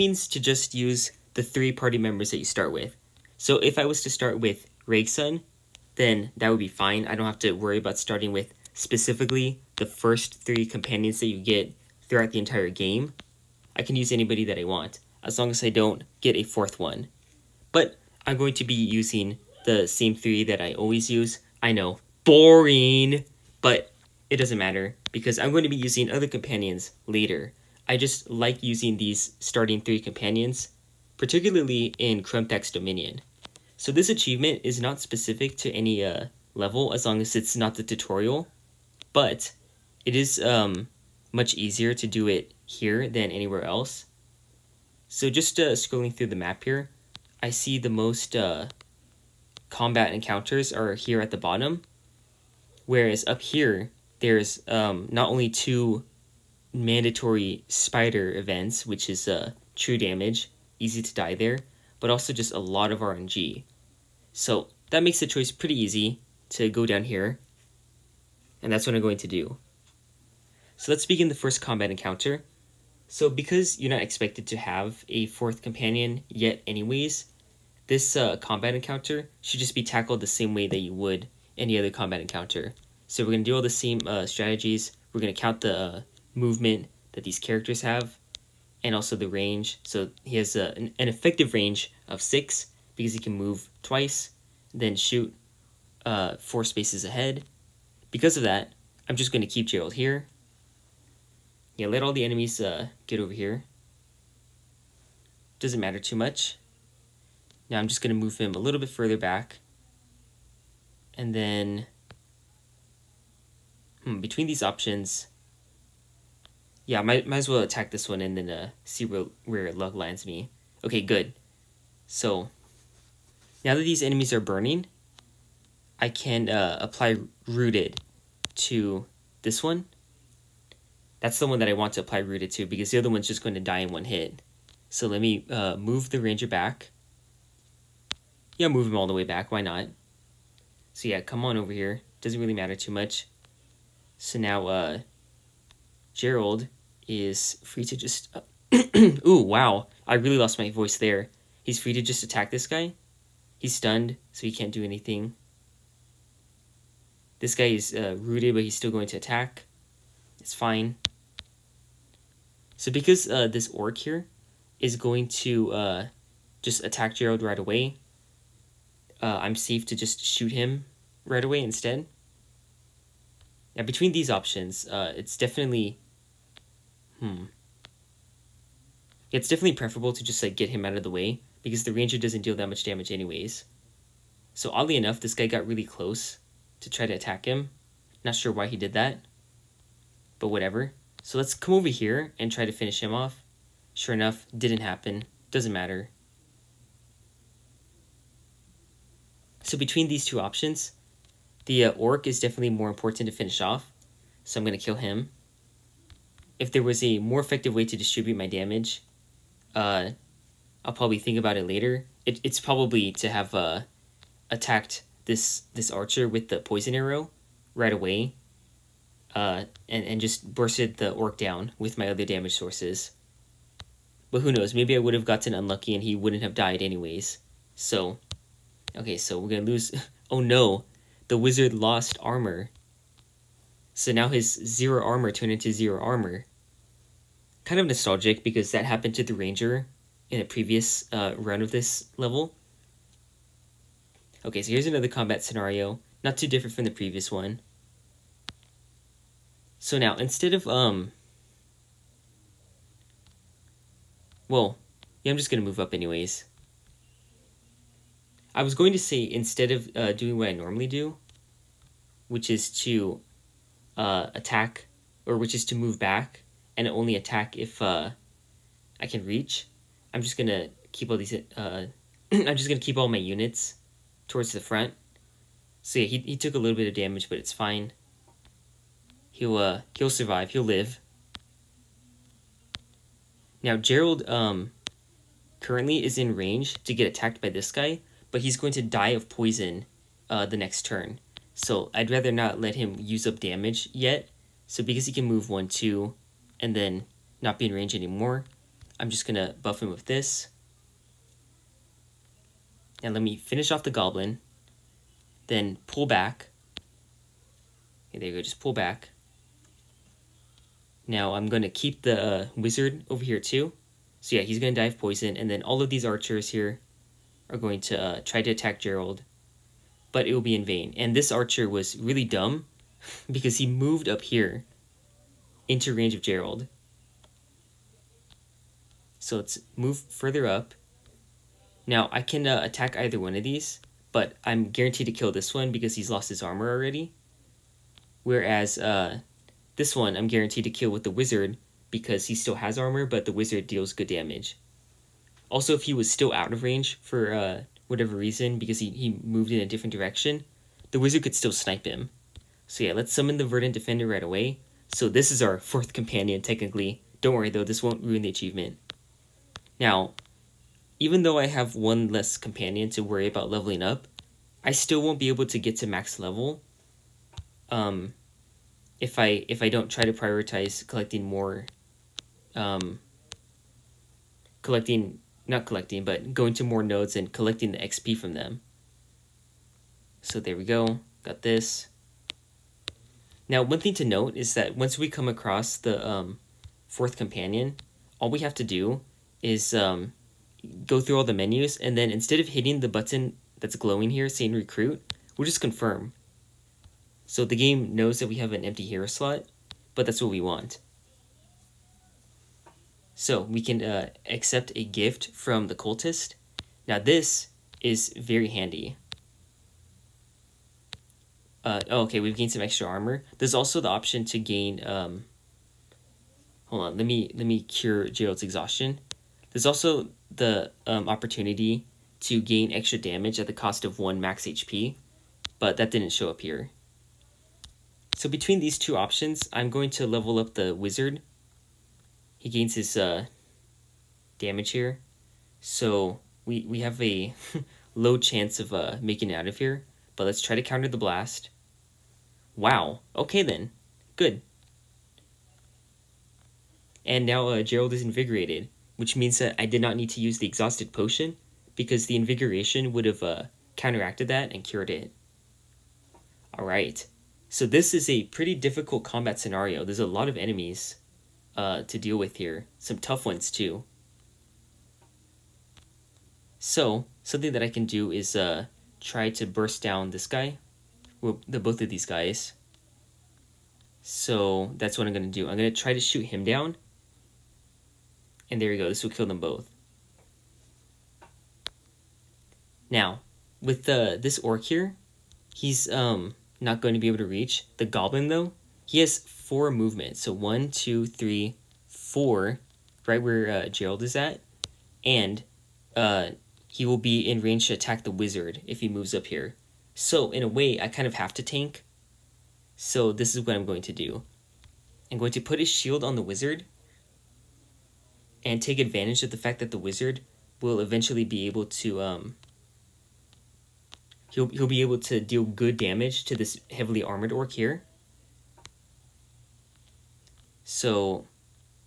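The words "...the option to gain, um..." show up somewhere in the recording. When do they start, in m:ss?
6:53.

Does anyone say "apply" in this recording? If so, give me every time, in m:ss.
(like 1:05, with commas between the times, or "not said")
2:06, 2:11.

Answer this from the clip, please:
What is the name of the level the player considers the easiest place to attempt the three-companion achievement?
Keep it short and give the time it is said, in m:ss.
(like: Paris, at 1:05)
Krumthak's Dominion, at 0:32.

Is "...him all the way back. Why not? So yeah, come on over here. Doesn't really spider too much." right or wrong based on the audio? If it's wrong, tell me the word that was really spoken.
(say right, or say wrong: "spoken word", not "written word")
wrong: "matter", not "spider".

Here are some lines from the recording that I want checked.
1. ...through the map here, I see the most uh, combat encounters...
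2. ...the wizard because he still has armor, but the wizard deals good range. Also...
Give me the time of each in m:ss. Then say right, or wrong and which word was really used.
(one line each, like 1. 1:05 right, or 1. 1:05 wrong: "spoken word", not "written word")
1. 0:46 right
2. 5:41 wrong: "damage", not "range".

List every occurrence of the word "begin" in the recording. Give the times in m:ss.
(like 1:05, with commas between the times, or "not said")
1:11.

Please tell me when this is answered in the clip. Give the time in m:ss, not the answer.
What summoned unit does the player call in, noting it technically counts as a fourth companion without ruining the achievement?
5:53.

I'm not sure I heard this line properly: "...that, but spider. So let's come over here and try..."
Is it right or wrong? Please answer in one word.
wrong.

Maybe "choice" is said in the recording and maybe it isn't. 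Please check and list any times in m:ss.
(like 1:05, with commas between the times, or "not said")
1:05.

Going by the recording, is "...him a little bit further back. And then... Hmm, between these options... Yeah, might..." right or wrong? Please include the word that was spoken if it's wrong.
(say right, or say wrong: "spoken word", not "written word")
right.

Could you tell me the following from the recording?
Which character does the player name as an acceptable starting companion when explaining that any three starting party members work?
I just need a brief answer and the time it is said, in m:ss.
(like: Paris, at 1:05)
Rakesun, at 0:04.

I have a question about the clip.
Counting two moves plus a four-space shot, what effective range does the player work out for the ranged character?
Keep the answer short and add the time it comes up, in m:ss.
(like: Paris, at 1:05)
6, at 1:32.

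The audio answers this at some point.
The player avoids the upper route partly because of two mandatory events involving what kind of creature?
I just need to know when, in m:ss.
0:57.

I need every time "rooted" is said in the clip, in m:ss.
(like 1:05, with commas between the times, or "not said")
2:07, 2:12, 2:38.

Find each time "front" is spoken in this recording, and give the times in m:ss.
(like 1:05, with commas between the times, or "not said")
4:34.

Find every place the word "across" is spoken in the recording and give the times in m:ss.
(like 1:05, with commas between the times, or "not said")
6:25.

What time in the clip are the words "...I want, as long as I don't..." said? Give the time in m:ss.
0:14.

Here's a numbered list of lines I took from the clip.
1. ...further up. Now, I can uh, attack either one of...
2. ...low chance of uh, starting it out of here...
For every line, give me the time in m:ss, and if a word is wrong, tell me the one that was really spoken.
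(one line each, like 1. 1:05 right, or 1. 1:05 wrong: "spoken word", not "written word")
1. 5:30 right
2. 7:17 wrong: "making", not "starting".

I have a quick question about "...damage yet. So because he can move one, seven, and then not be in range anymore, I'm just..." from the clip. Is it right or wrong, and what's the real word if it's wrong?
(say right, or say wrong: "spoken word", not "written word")
wrong: "two", not "seven".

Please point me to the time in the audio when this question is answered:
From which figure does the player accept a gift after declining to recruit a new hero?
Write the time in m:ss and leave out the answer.
6:45.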